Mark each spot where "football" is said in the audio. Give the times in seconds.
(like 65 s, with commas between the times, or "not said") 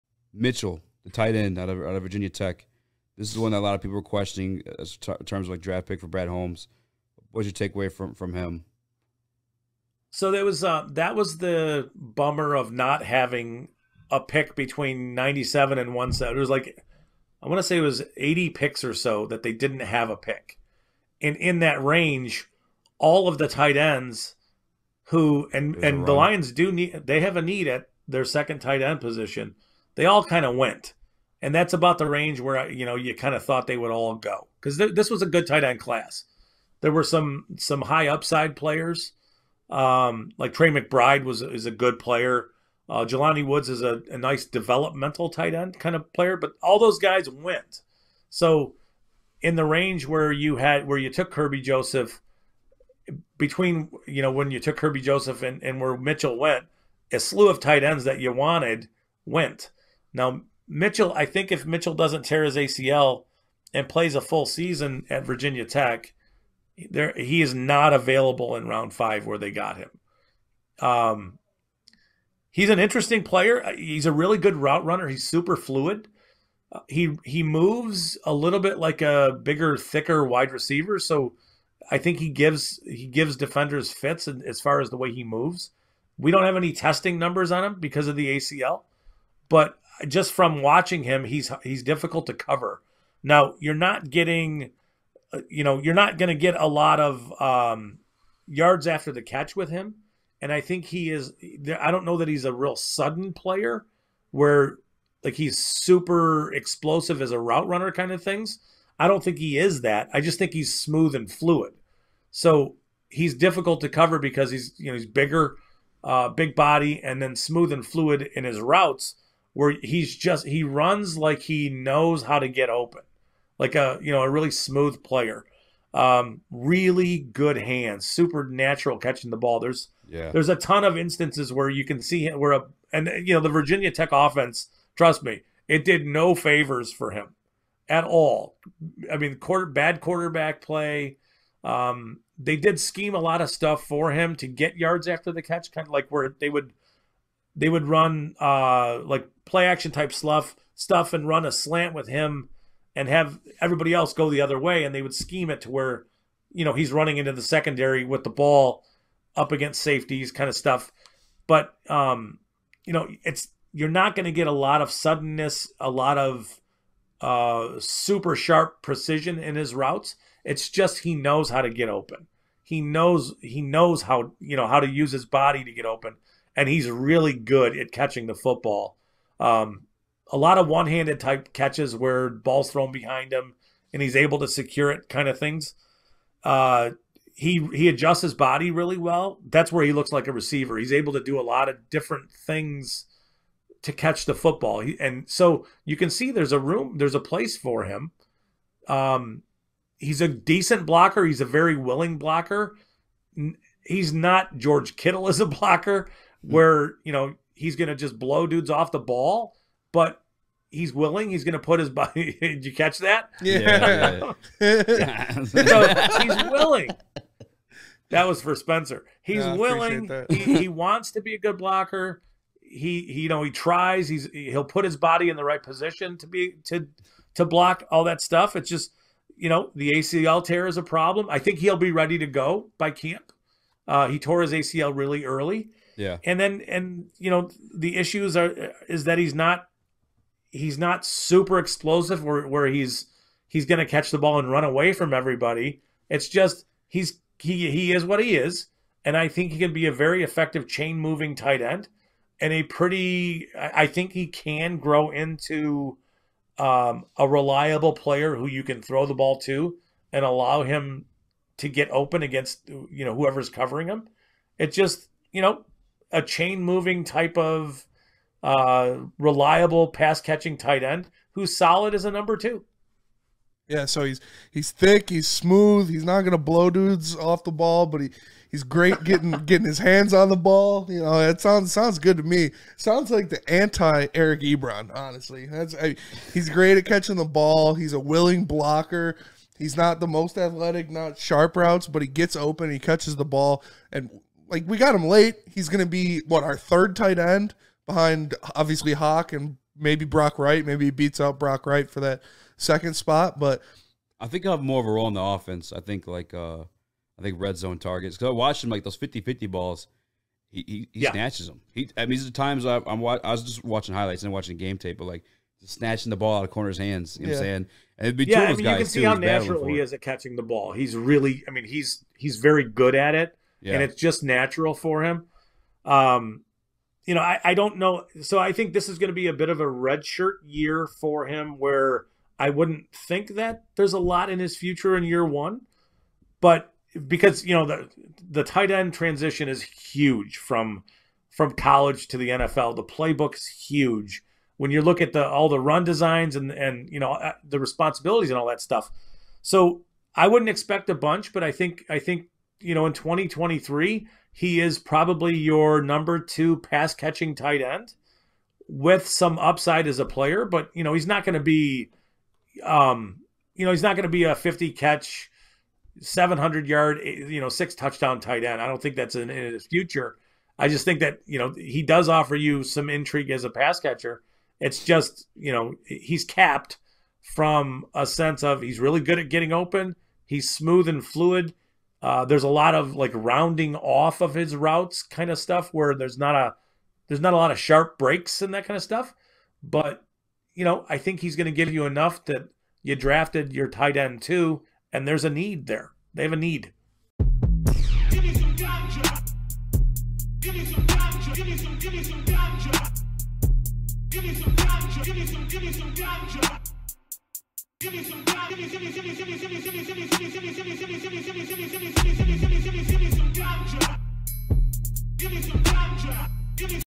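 178 s, 194 s.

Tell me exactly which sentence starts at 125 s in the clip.
Um, really good hands, supernatural catching the ball.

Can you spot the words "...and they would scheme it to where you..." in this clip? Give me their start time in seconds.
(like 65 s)
154 s.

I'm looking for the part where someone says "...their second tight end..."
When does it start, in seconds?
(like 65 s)
28 s.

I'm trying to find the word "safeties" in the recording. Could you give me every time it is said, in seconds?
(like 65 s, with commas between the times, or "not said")
159 s.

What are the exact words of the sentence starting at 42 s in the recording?
Uh, Jelani Woods is a, a nice developmental tight end kind of player, but all those guys went.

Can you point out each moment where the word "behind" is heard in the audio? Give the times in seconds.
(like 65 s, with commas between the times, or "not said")
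182 s, 297 s.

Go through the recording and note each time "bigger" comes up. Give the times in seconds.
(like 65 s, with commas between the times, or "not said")
79 s, 115 s.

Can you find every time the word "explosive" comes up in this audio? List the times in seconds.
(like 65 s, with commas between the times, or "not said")
106 s, 241 s.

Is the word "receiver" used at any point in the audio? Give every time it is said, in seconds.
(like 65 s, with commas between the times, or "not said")
80 s, 190 s.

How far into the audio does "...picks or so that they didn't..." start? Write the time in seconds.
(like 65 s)
18 s.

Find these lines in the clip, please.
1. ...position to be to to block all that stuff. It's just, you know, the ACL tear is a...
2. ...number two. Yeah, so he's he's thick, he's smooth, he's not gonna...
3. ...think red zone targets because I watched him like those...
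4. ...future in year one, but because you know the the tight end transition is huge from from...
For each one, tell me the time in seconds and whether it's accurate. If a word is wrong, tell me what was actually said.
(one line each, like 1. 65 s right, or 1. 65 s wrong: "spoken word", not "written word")
1. 225 s right
2. 272 s right
3. 307 s right
4. 334 s right.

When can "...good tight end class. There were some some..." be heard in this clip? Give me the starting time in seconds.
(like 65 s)
35 s.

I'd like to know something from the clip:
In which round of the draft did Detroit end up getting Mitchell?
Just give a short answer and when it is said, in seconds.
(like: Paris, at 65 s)
Round 5, at 68 s.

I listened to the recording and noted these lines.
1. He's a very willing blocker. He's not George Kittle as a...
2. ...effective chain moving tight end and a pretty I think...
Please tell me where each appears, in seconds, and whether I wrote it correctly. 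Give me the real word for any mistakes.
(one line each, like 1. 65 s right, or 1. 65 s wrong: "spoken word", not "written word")
1. 201 s right
2. 250 s right.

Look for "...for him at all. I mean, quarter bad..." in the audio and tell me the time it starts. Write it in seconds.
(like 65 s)
136 s.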